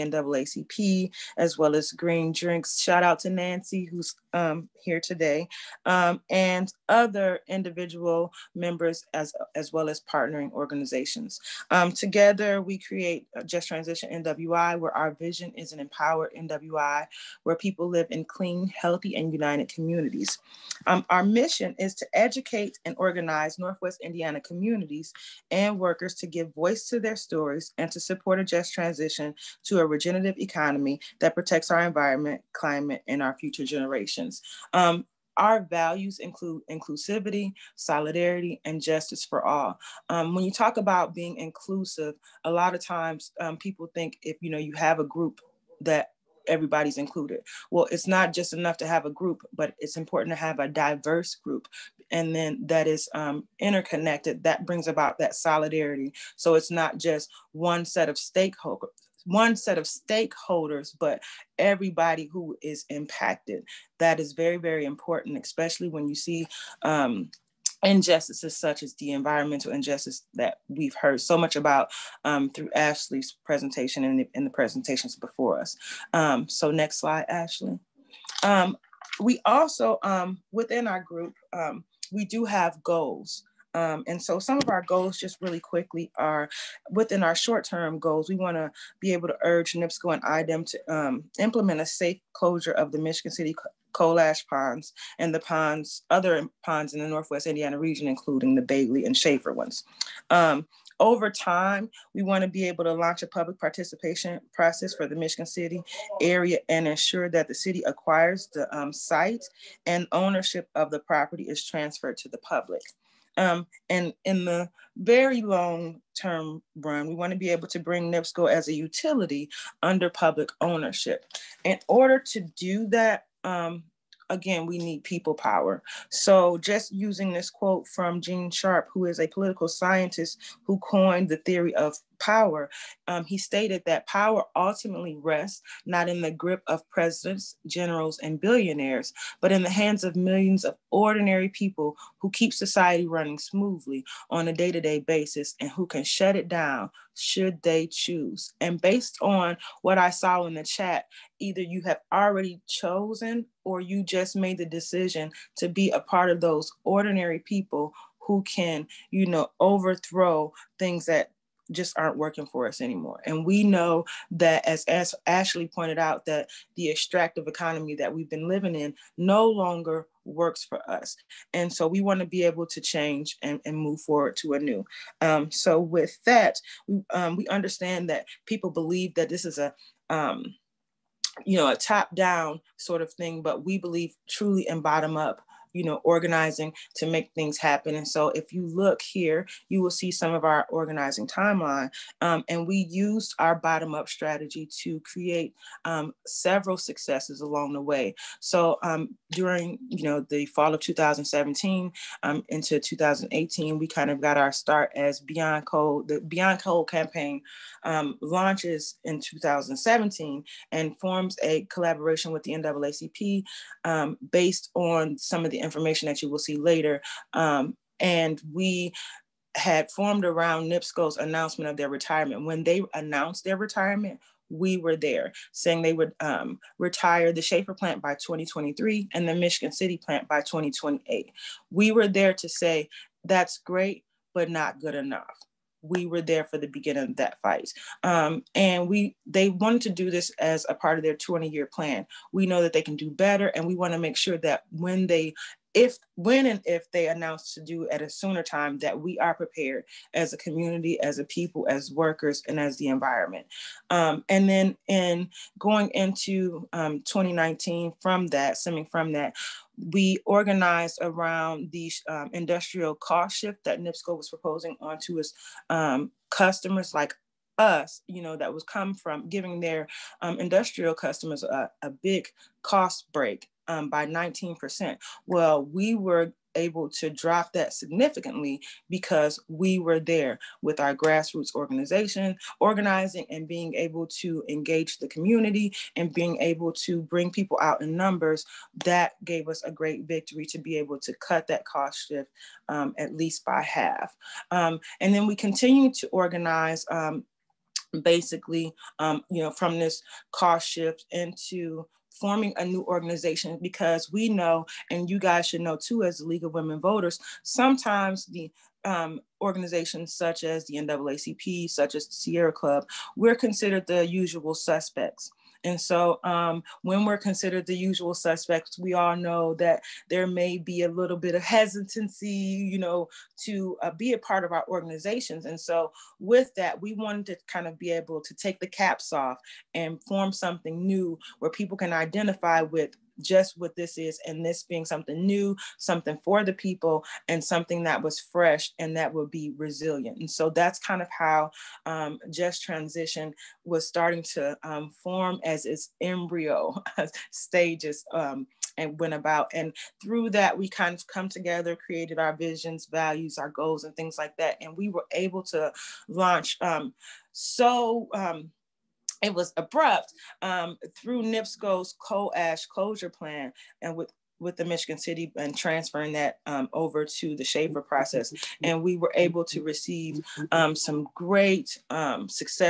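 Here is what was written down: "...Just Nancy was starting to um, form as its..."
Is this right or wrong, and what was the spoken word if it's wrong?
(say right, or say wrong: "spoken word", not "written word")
wrong: "Transition", not "Nancy".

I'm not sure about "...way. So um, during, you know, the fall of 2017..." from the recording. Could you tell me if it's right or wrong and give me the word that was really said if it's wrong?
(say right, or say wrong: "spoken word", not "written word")
right.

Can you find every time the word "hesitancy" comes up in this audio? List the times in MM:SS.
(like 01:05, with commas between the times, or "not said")
05:21.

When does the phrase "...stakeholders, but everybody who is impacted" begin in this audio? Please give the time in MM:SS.
00:59.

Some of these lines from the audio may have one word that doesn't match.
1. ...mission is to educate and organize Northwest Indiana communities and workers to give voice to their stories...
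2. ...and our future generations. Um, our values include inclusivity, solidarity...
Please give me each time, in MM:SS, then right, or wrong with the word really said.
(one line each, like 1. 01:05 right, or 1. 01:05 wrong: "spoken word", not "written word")
1. 00:21 right
2. 00:33 right.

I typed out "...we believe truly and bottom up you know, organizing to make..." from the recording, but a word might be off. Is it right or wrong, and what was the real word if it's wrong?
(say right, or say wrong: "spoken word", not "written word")
right.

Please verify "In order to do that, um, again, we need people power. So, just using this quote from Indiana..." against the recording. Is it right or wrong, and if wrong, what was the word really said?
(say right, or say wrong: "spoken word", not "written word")
wrong: "Gene", not "Indiana".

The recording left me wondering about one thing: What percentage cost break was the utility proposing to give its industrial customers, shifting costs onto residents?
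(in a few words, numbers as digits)
19%.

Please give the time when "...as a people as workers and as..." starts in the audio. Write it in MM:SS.
04:11.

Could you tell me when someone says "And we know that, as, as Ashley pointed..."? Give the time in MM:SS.
02:43.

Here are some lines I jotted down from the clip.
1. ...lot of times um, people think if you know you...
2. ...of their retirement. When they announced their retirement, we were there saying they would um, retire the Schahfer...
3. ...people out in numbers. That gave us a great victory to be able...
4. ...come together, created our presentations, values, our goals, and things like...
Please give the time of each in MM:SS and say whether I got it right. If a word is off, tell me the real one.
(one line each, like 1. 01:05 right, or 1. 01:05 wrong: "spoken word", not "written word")
1. 00:42 right
2. 03:41 right
3. 04:47 right
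4. 05:51 wrong: "visions", not "presentations".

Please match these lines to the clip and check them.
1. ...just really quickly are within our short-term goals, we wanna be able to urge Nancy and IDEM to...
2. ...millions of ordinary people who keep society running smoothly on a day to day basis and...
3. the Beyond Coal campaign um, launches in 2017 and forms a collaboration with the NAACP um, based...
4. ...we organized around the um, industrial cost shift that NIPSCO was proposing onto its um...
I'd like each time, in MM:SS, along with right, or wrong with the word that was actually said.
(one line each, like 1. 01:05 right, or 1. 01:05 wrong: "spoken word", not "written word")
1. 01:25 wrong: "NIPSCO", not "Nancy"
2. 02:20 right
3. 03:26 right
4. 04:19 right.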